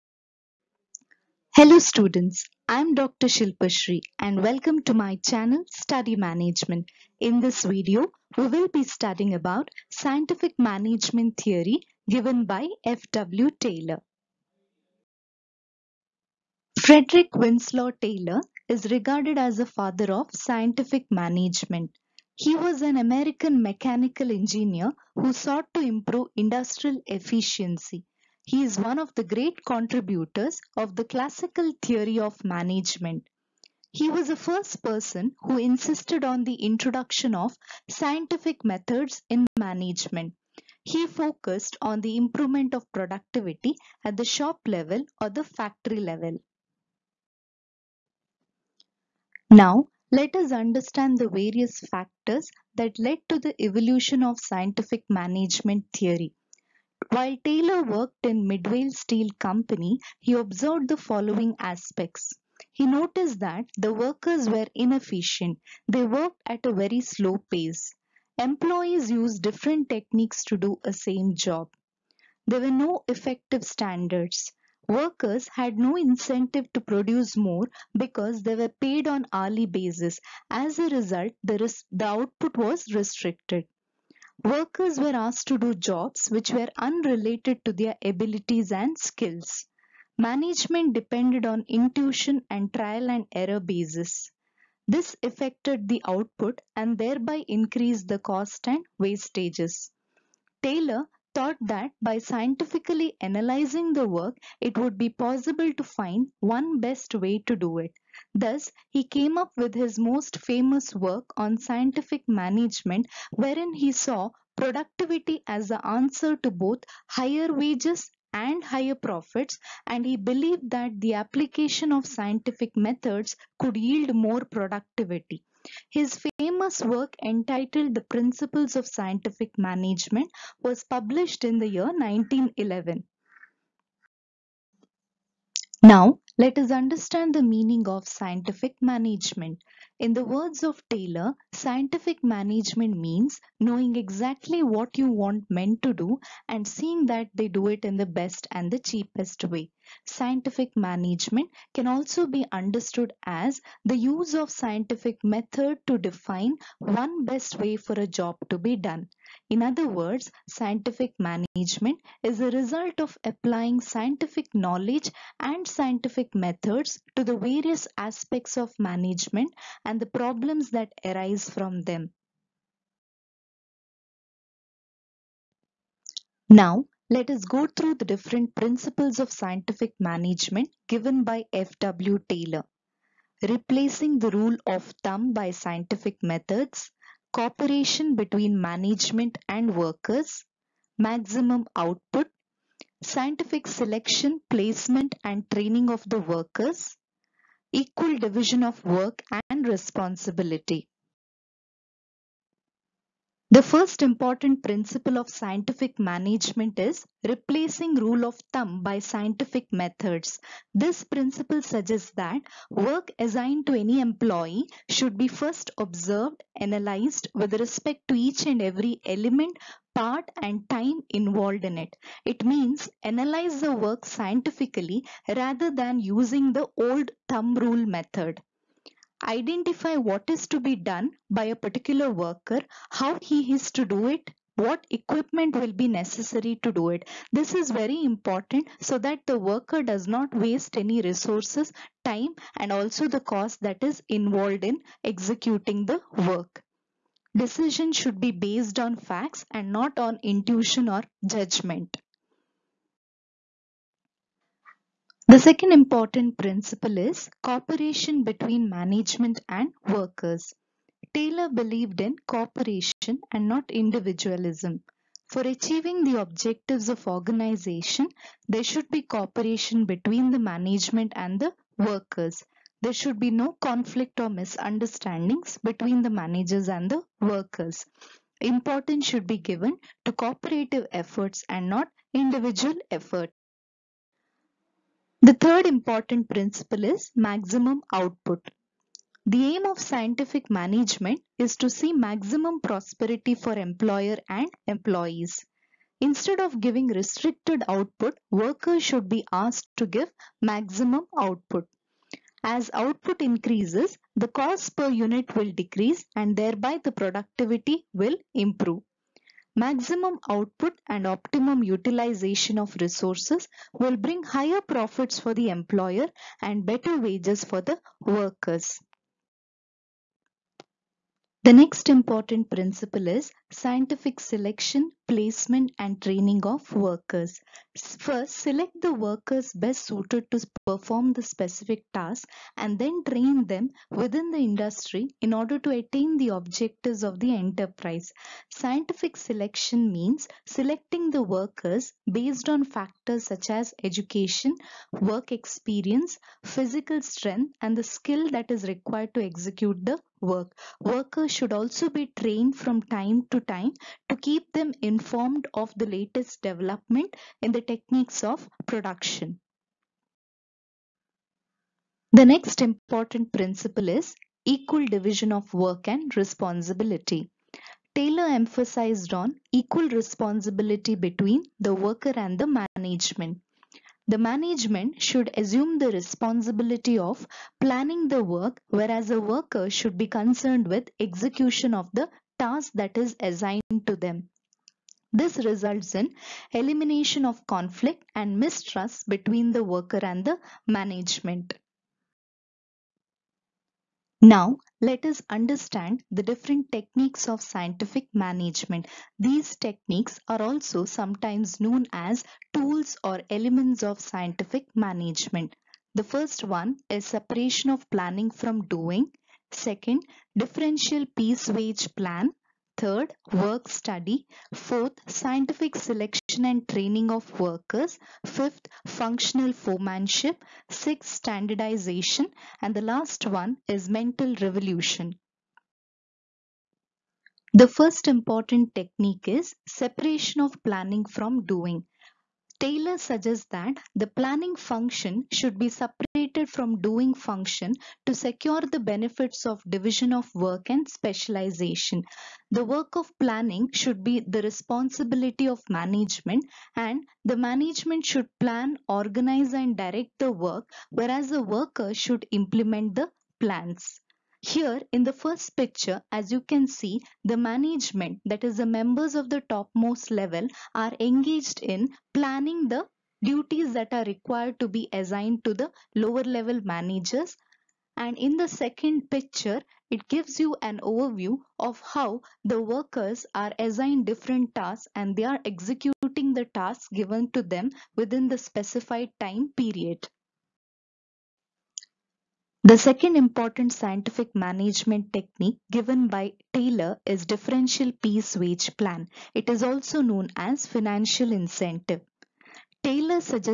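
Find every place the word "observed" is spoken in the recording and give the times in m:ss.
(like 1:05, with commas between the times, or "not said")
1:00, 3:35.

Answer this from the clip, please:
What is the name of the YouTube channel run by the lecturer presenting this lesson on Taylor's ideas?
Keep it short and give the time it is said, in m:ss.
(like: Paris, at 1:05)
Study Management, at 0:05.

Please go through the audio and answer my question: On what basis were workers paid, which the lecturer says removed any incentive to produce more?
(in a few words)
Hourly basis.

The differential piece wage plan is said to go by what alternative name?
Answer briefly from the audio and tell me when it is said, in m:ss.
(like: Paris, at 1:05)
Financial incentive, at 8:10.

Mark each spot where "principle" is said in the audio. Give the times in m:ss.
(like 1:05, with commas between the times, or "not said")
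2:08, 2:58, 3:24, 3:31, 4:16, 4:46, 5:22, 6:03.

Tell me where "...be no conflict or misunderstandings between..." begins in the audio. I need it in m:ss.
4:33.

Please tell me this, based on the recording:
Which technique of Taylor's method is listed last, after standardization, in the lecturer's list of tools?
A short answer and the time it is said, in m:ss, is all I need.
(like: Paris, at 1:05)
Mental revolution, at 7:03.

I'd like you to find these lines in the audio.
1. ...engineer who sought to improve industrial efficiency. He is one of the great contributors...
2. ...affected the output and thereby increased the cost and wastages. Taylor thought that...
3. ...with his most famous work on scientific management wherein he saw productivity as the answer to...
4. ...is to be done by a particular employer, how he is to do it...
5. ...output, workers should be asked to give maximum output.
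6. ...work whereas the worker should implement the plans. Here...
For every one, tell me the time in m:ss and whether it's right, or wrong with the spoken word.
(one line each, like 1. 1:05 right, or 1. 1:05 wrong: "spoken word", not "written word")
1. 0:24 right
2. 1:35 right
3. 1:49 right
4. 3:50 wrong: "worker", not "employer"
5. 4:57 right
6. 7:30 right.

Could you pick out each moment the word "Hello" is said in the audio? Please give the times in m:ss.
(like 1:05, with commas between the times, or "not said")
0:01.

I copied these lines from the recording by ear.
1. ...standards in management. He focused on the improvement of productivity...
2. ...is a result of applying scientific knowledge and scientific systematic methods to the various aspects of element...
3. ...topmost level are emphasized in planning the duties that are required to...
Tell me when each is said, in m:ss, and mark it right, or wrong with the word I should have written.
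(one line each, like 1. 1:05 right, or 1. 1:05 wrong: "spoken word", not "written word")
1. 0:38 wrong: "methods", not "standards"
2. 2:42 wrong: "management", not "element"
3. 7:39 wrong: "engaged", not "emphasized".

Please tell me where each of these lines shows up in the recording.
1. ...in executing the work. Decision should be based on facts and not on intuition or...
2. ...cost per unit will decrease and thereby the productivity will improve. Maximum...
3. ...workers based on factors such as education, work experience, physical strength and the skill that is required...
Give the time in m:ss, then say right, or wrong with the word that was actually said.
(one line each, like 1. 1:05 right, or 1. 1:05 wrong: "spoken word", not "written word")
1. 4:04 right
2. 5:04 right
3. 5:41 right.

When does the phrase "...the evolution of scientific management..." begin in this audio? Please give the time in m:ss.
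0:53.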